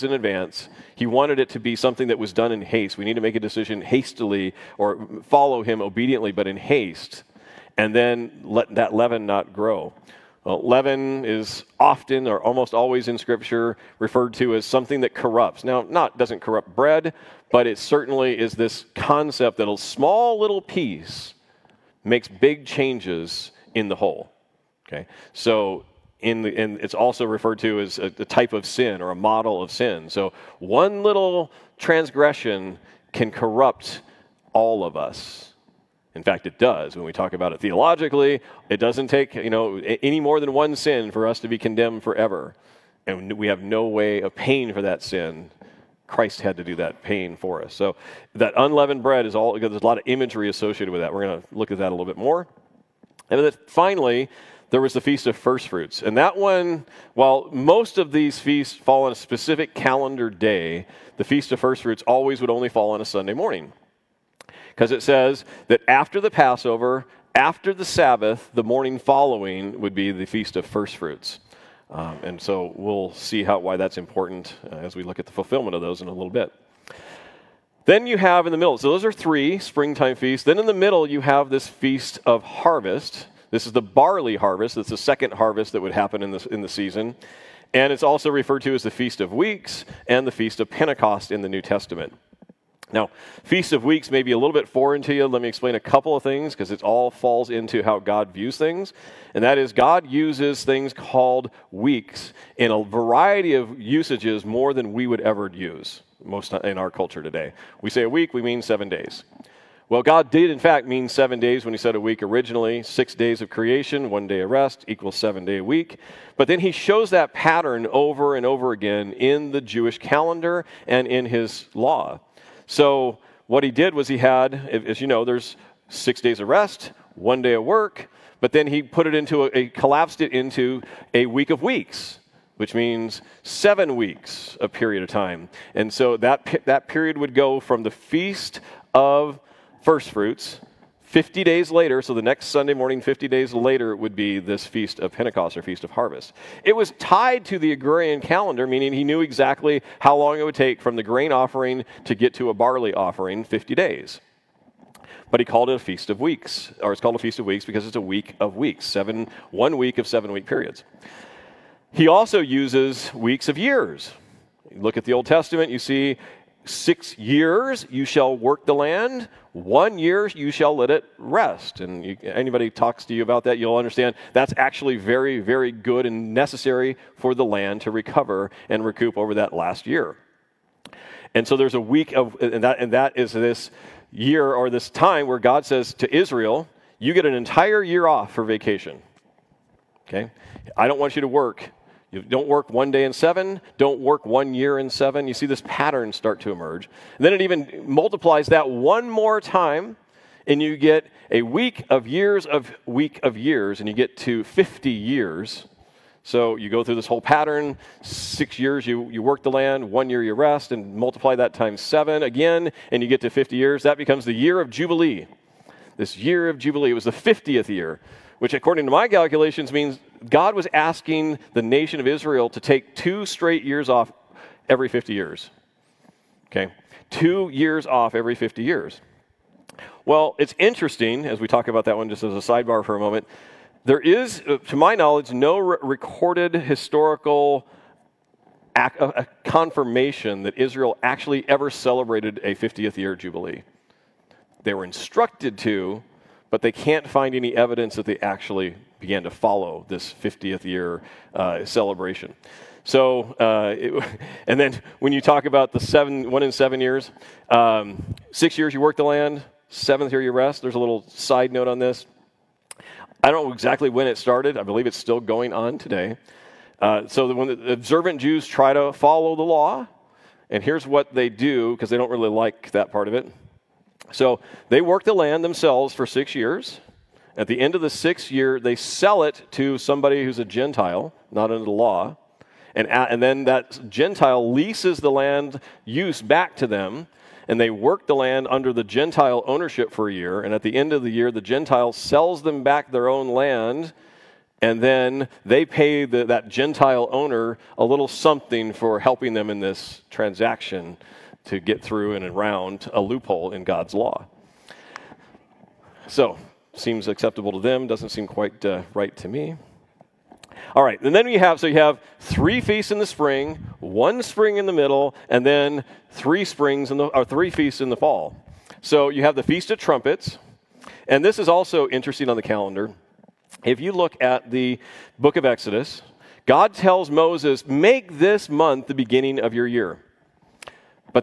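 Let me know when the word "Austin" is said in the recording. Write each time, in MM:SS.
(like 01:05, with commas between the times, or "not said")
not said.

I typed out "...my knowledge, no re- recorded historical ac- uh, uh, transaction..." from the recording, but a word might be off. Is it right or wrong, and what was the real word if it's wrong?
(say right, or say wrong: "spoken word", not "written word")
wrong: "confirmation", not "transaction".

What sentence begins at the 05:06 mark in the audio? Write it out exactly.
So seems acceptable to them, doesn't seem quite uh, right to me.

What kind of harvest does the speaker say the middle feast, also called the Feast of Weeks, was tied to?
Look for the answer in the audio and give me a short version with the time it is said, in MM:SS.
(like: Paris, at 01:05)
barley harvest, at 01:23.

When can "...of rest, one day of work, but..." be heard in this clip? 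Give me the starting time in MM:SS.
02:06.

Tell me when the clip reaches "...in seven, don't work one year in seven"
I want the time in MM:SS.
03:13.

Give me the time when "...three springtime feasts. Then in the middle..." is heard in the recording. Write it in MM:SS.
01:19.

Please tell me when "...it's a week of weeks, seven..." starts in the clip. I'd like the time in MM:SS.
02:37.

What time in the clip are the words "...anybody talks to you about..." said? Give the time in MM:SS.
02:52.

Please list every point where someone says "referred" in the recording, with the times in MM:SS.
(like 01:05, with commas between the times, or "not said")
00:13, 00:27, 01:28.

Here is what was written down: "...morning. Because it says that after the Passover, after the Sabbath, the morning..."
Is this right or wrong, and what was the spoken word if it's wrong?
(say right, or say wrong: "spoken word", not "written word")
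right.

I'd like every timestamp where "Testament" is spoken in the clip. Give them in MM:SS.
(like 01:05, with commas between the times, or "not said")
01:31, 02:45.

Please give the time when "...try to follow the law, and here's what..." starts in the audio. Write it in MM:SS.
04:28.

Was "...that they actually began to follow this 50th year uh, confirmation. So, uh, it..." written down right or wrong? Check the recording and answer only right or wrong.
wrong.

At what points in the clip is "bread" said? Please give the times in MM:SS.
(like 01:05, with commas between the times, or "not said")
00:16, 00:49.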